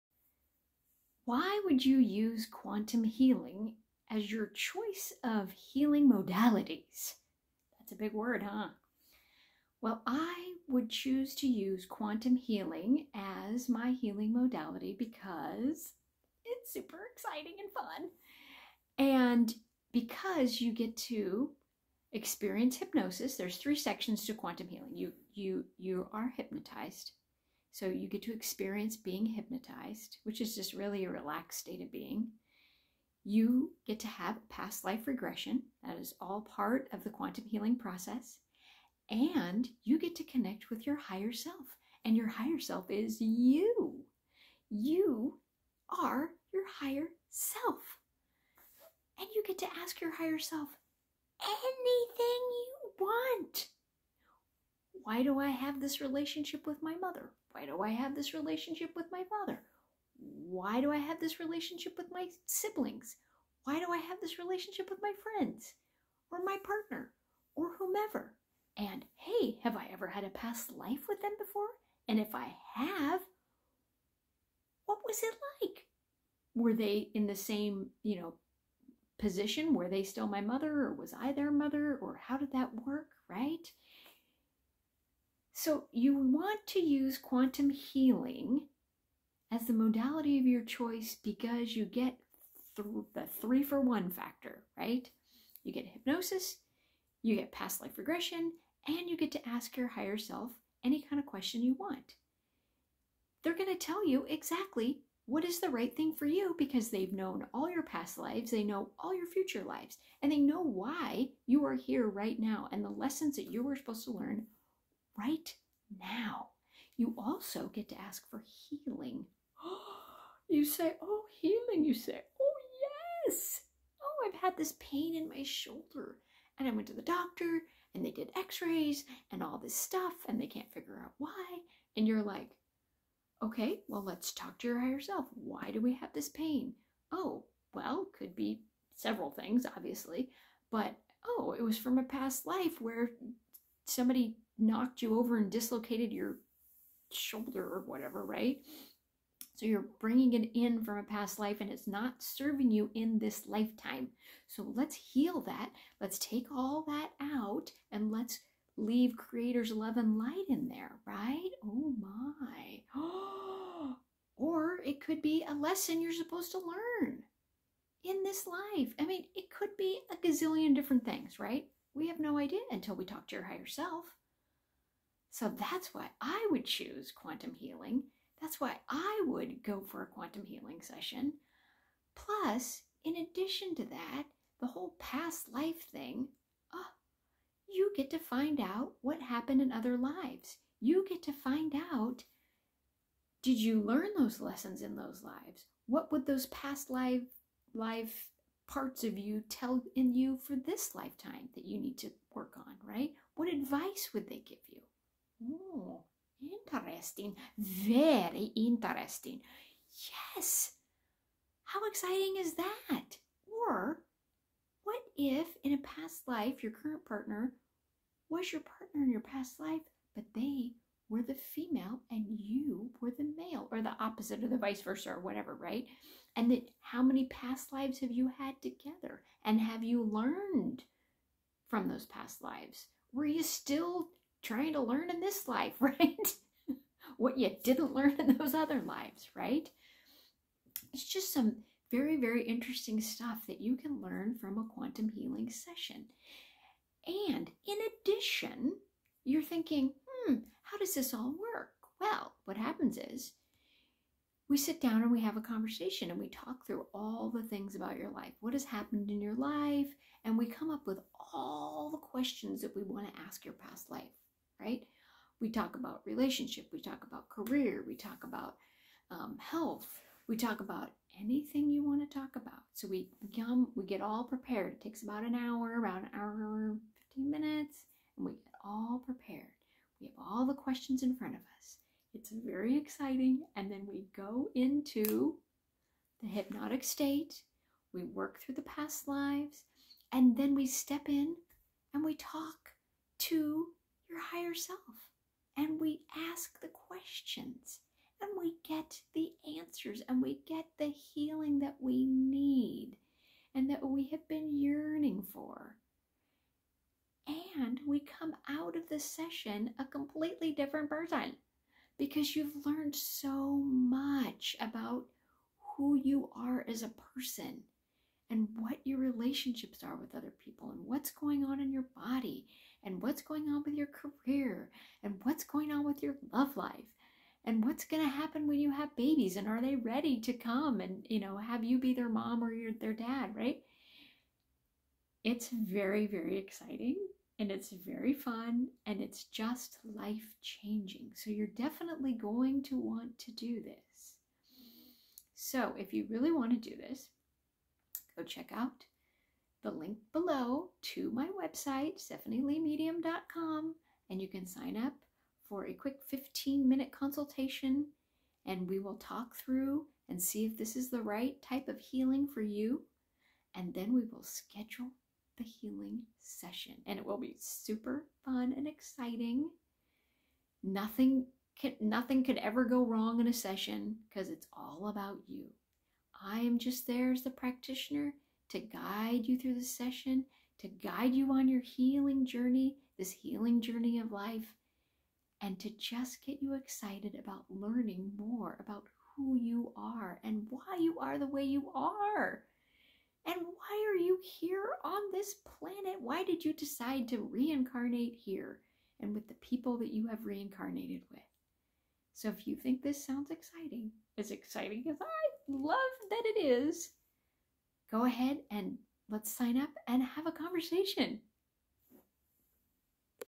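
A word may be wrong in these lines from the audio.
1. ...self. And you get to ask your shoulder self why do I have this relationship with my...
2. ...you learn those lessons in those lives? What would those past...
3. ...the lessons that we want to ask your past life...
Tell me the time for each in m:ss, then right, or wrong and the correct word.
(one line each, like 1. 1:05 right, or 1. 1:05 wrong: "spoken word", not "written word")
1. 0:47 wrong: "higher", not "shoulder"
2. 3:13 right
3. 4:21 wrong: "questions", not "lessons".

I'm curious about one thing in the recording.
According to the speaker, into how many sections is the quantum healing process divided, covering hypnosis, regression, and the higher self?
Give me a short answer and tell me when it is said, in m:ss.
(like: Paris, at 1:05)
3, at 0:23.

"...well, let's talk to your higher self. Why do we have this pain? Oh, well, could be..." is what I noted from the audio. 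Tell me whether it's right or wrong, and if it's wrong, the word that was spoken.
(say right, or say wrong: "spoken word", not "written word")
right.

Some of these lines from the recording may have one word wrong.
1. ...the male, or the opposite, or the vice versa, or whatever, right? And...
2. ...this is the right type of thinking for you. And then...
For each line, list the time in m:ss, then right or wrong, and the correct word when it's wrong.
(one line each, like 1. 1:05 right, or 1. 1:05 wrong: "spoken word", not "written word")
1. 3:43 right
2. 6:00 wrong: "healing", not "thinking".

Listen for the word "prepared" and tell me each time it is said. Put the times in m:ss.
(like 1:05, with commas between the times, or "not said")
4:34, 4:39.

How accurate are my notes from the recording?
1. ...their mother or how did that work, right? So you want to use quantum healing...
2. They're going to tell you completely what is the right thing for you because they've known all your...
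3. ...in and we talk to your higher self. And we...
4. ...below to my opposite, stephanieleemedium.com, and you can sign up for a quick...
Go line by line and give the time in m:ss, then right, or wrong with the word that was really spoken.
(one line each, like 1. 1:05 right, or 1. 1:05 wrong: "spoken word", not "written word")
1. 1:21 right
2. 1:43 wrong: "exactly", not "completely"
3. 4:51 right
4. 5:50 wrong: "website", not "opposite".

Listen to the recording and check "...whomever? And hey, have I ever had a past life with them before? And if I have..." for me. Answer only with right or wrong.
right.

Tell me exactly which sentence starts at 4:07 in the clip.
And in addition, you're thinking, hmm, how does this all work?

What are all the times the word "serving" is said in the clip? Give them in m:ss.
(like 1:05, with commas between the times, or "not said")
2:32.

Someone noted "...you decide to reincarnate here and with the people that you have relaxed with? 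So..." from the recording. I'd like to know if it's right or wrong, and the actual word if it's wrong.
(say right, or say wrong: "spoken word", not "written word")
wrong: "reincarnated", not "relaxed".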